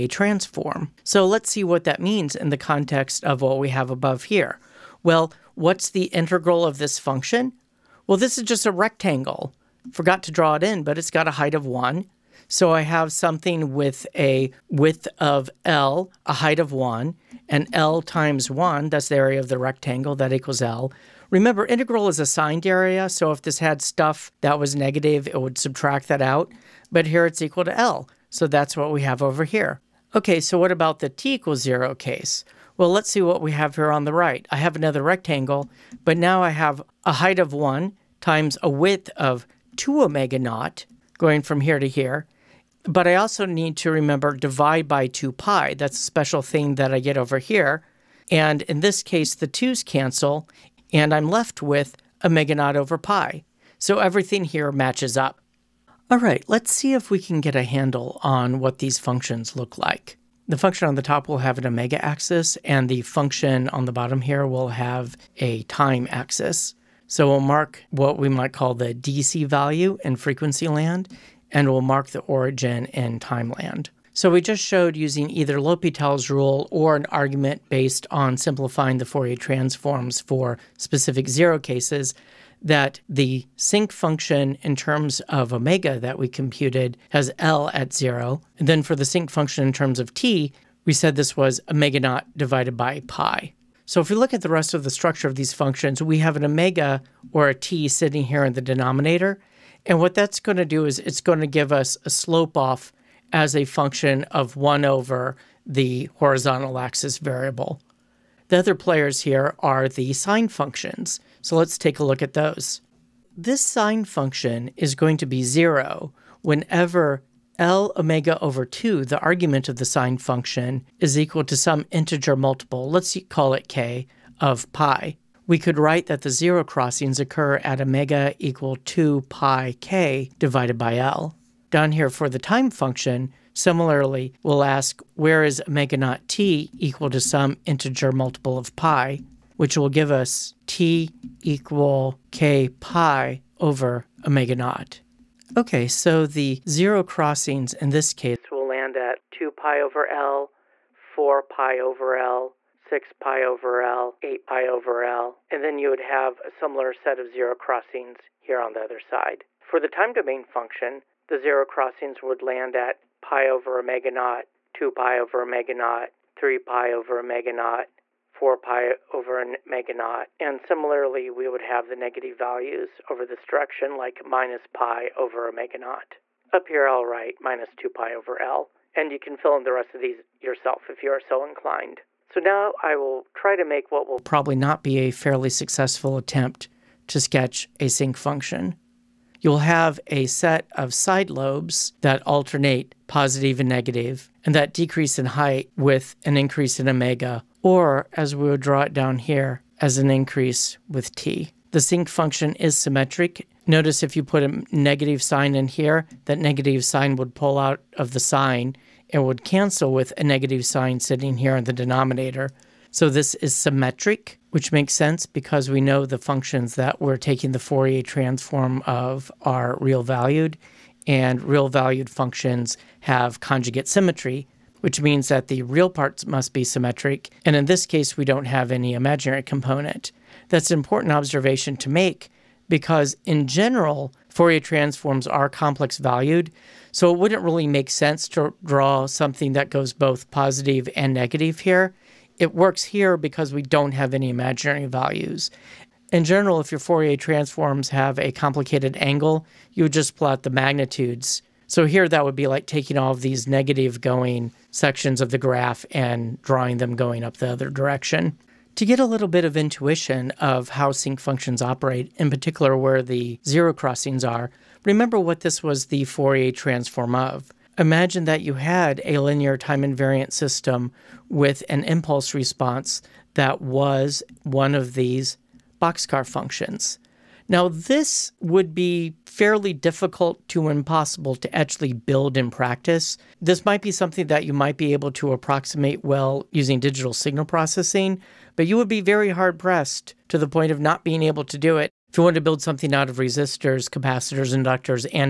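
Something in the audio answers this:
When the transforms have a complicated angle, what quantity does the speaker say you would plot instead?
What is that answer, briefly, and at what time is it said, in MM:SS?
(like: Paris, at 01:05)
The magnitudes, at 04:10.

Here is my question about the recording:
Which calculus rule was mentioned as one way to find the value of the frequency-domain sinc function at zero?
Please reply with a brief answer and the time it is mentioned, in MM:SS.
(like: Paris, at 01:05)
L'Hopital's rule, at 01:15.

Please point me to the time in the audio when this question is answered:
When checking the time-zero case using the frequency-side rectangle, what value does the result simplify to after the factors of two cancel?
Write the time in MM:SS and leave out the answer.
00:52.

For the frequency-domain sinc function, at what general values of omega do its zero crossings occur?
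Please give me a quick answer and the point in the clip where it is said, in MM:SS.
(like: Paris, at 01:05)
2 pi k / L, at 02:08.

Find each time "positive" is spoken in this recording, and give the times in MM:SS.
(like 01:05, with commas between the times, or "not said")
03:13, 04:00.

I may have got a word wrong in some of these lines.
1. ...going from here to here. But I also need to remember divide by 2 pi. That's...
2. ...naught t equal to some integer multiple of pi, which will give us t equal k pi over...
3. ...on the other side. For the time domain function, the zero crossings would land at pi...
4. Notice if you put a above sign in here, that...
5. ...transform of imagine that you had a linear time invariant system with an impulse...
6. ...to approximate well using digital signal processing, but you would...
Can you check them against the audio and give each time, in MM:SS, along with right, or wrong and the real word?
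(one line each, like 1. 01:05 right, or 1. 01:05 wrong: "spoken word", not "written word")
1. 00:41 right
2. 02:15 right
3. 02:38 right
4. 03:23 wrong: "negative", not "above"
5. 04:26 right
6. 04:45 right.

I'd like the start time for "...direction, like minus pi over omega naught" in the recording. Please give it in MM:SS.
02:53.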